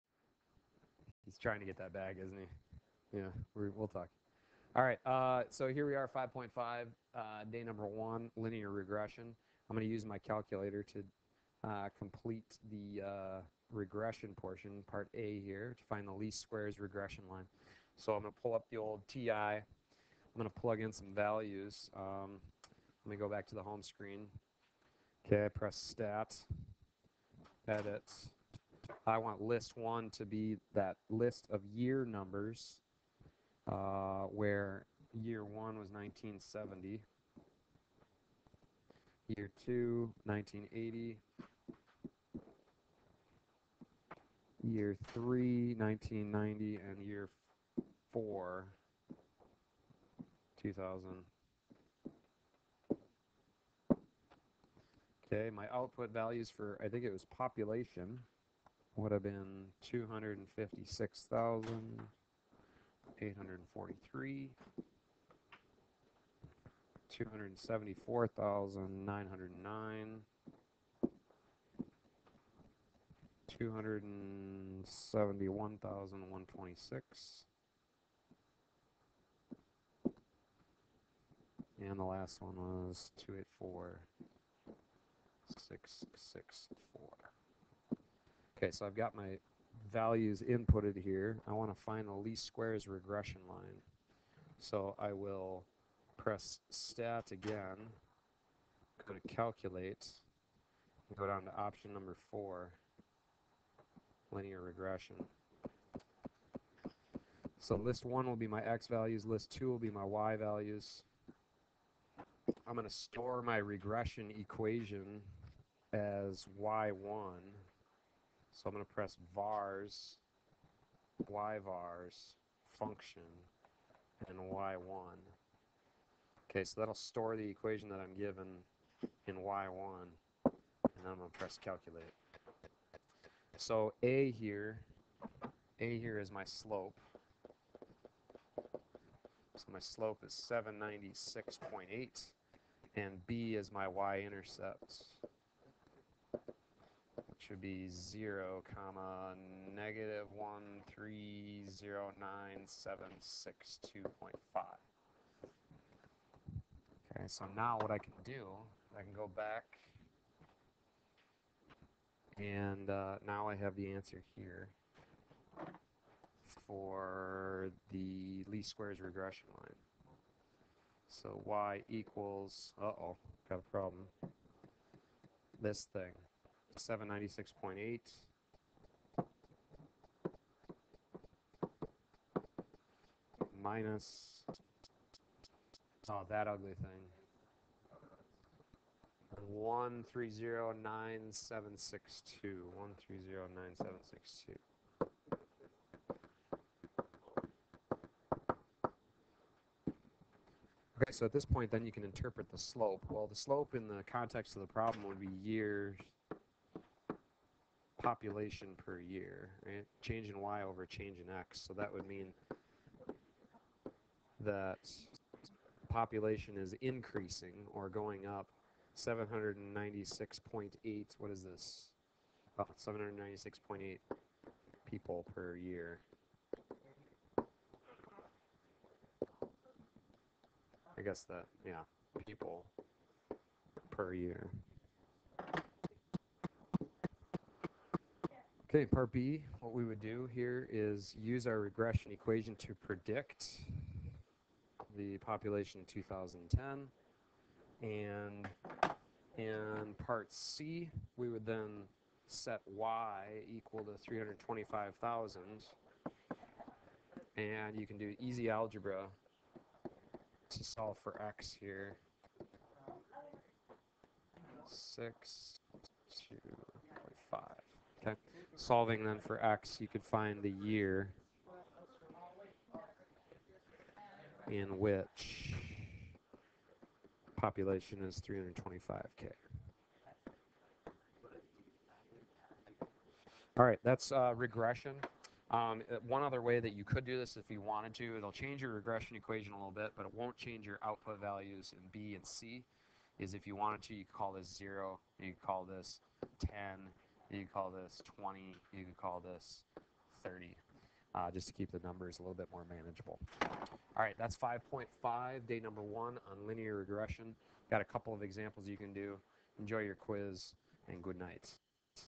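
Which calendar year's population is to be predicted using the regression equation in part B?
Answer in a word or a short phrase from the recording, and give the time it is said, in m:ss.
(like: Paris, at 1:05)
2010, at 4:05.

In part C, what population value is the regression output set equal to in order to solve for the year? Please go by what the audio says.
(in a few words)
325,000.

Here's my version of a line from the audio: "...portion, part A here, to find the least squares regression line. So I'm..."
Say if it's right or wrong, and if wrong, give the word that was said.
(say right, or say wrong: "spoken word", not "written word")
right.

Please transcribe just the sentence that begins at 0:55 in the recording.
Okay, my output values for, I think it was population.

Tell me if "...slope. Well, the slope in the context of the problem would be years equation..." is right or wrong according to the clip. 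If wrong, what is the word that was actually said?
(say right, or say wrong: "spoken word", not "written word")
wrong: "population", not "equation".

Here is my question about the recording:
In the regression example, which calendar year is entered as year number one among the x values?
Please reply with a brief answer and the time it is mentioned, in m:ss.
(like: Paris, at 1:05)
1970, at 0:35.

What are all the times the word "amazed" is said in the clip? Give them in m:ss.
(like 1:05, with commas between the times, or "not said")
not said.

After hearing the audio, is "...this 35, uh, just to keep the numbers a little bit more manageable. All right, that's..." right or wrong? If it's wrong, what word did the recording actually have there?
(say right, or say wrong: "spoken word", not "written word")
wrong: "30", not "35".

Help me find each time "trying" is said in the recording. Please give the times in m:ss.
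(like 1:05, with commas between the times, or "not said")
0:01.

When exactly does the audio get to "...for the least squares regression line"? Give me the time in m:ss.
2:46.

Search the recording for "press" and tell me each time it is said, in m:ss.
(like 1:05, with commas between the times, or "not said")
0:25, 1:36, 1:58, 2:11.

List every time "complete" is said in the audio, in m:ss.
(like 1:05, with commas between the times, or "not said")
0:11.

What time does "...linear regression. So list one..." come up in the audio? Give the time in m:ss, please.
1:44.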